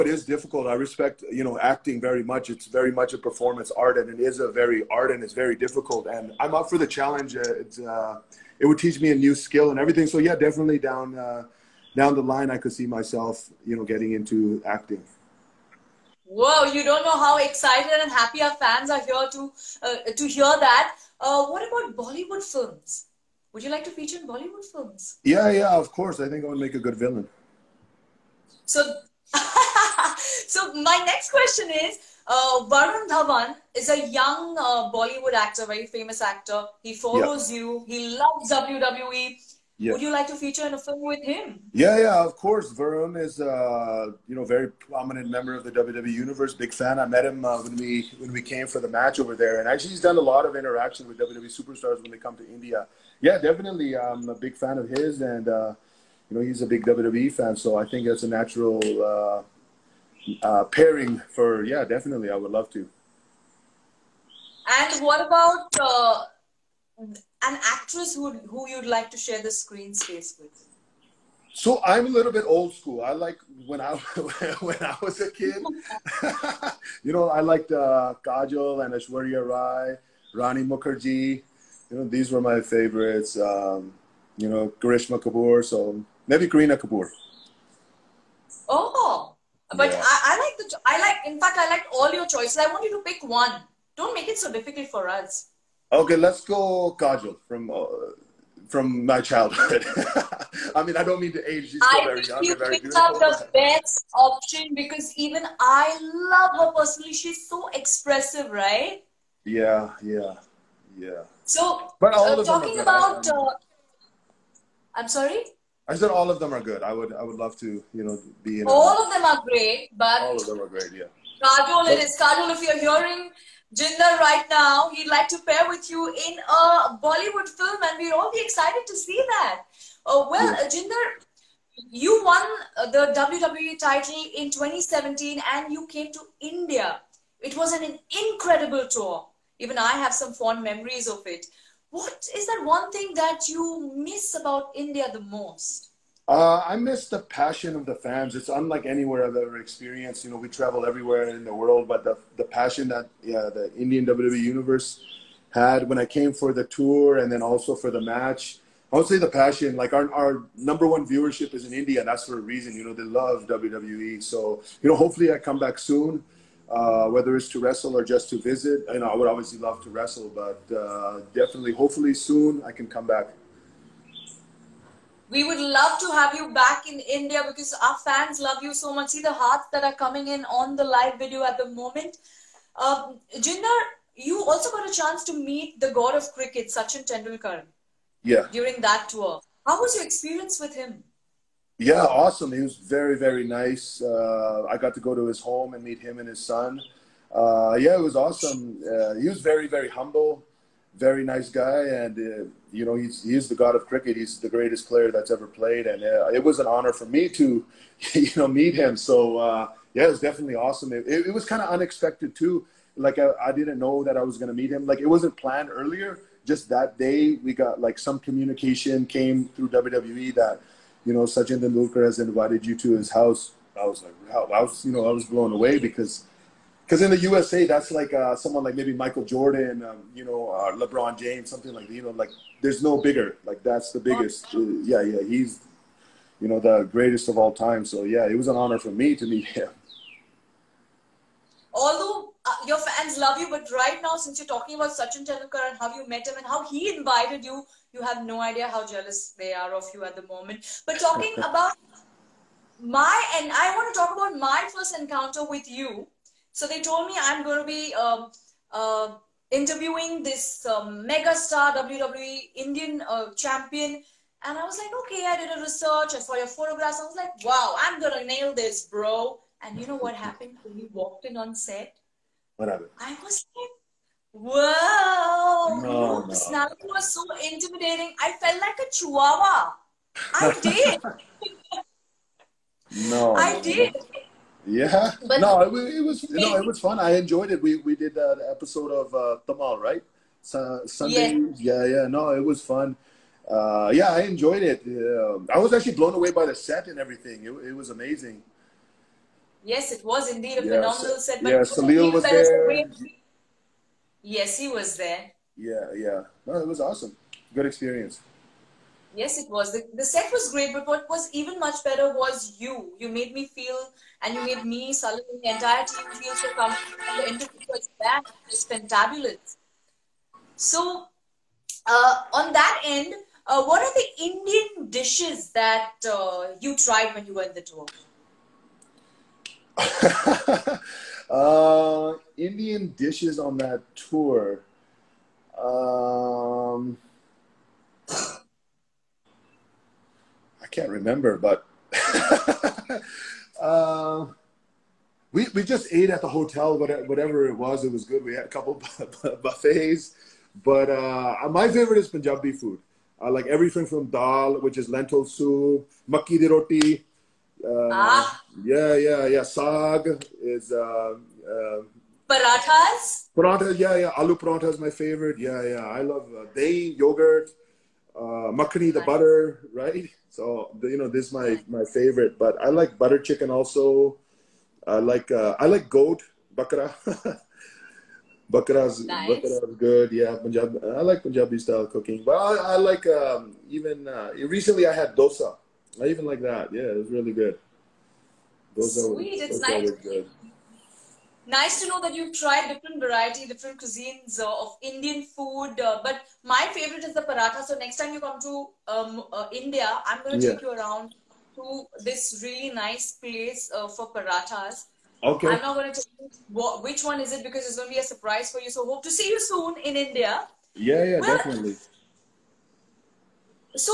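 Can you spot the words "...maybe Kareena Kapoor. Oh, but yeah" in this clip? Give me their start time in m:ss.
1:26.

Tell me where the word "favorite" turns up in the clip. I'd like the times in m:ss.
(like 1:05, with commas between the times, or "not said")
1:22, 5:51, 6:04, 6:11, 6:36.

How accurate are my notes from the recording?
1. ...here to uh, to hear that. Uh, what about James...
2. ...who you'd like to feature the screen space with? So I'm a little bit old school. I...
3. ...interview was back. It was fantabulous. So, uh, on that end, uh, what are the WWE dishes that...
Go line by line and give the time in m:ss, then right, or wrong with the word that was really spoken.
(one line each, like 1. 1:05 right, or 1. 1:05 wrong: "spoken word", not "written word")
1. 0:18 wrong: "Bollywood", not "James"
2. 1:08 wrong: "share", not "feature"
3. 5:17 wrong: "Indian", not "WWE".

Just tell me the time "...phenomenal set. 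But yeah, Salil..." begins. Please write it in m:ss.
5:00.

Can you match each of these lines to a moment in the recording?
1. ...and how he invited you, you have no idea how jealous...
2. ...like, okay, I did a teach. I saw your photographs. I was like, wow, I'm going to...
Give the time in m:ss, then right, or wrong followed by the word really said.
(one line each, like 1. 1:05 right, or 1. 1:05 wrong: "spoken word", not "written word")
1. 4:06 right
2. 4:24 wrong: "research", not "teach".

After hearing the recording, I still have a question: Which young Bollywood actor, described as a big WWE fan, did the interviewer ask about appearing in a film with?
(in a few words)
Varun Dhawan.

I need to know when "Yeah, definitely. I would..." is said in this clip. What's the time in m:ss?
1:01.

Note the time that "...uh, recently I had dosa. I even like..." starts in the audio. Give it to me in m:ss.
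6:24.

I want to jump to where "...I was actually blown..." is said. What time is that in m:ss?
4:55.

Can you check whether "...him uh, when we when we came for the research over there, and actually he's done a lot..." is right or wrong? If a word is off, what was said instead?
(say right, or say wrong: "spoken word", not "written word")
wrong: "match", not "research".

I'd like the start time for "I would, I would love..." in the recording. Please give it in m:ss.
1:56.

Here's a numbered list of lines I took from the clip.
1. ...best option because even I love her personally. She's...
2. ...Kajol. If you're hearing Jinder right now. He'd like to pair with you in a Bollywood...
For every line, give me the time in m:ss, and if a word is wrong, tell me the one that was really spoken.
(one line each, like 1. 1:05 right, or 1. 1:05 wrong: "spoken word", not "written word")
1. 1:43 right
2. 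2:02 right.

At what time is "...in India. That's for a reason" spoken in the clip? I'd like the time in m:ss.
2:41.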